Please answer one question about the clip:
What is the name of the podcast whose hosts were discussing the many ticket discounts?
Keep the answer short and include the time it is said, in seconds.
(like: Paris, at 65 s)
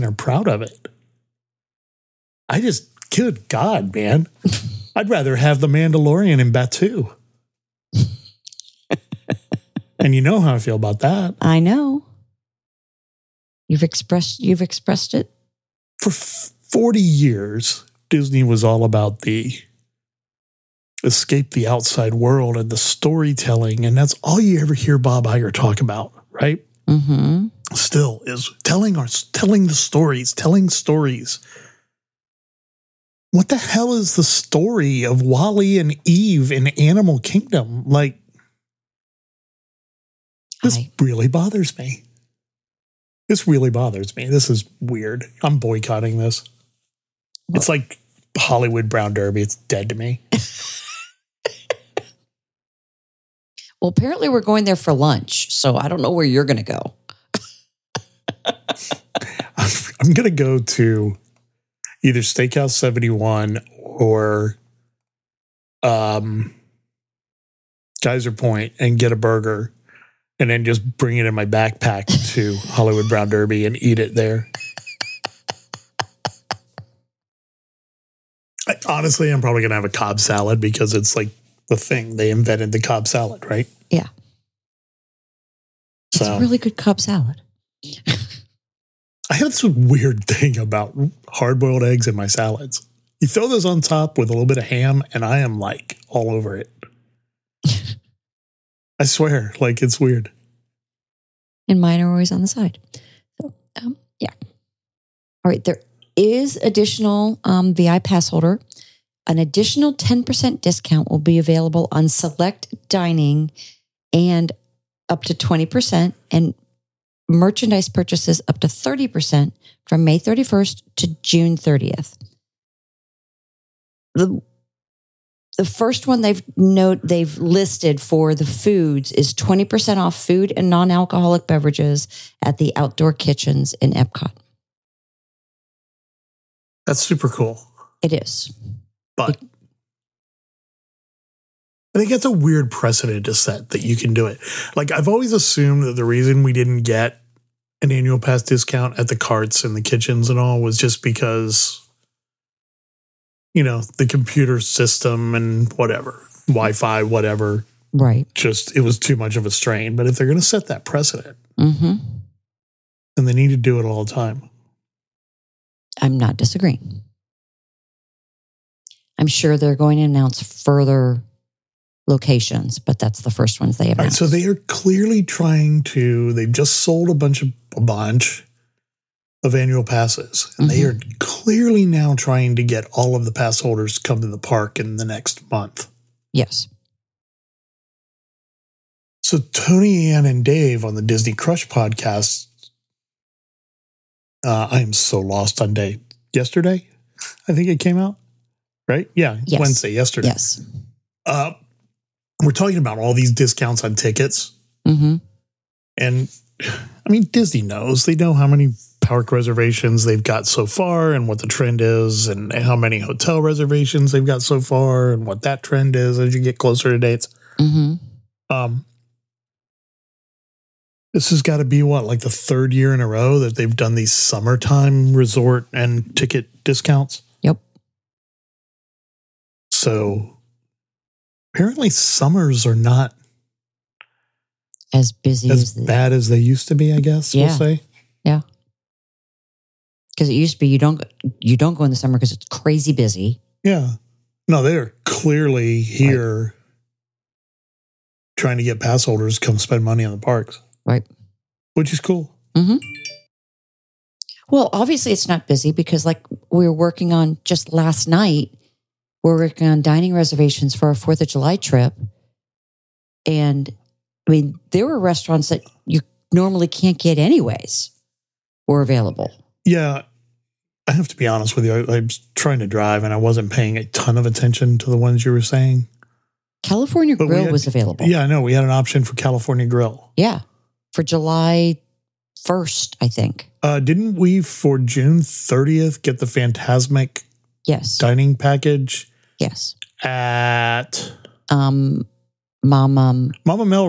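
Disney Crush, at 191 s.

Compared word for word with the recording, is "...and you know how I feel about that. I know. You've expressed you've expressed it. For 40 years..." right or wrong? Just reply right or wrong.
right.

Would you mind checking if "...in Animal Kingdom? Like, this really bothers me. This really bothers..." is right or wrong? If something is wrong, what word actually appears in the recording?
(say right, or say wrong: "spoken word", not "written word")
right.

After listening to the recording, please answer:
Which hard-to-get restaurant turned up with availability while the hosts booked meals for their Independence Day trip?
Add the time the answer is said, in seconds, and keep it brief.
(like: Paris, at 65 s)
California Grill, at 276 s.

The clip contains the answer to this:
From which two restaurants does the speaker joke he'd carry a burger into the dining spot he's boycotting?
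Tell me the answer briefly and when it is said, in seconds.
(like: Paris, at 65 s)
Steakhouse 71 or Geyser Point, at 62 s.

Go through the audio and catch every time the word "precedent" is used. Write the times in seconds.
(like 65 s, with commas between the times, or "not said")
142 s, 160 s.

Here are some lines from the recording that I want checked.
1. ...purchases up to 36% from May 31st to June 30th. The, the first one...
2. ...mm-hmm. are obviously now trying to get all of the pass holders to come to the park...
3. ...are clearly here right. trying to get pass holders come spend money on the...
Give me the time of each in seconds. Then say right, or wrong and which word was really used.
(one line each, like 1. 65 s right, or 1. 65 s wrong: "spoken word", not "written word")
1. 117 s wrong: "30", not "36"
2. 180 s wrong: "clearly", not "obviously"
3. 244 s right.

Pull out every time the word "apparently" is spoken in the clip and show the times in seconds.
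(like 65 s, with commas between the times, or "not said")
53 s, 231 s.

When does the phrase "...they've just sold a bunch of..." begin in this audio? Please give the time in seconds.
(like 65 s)
176 s.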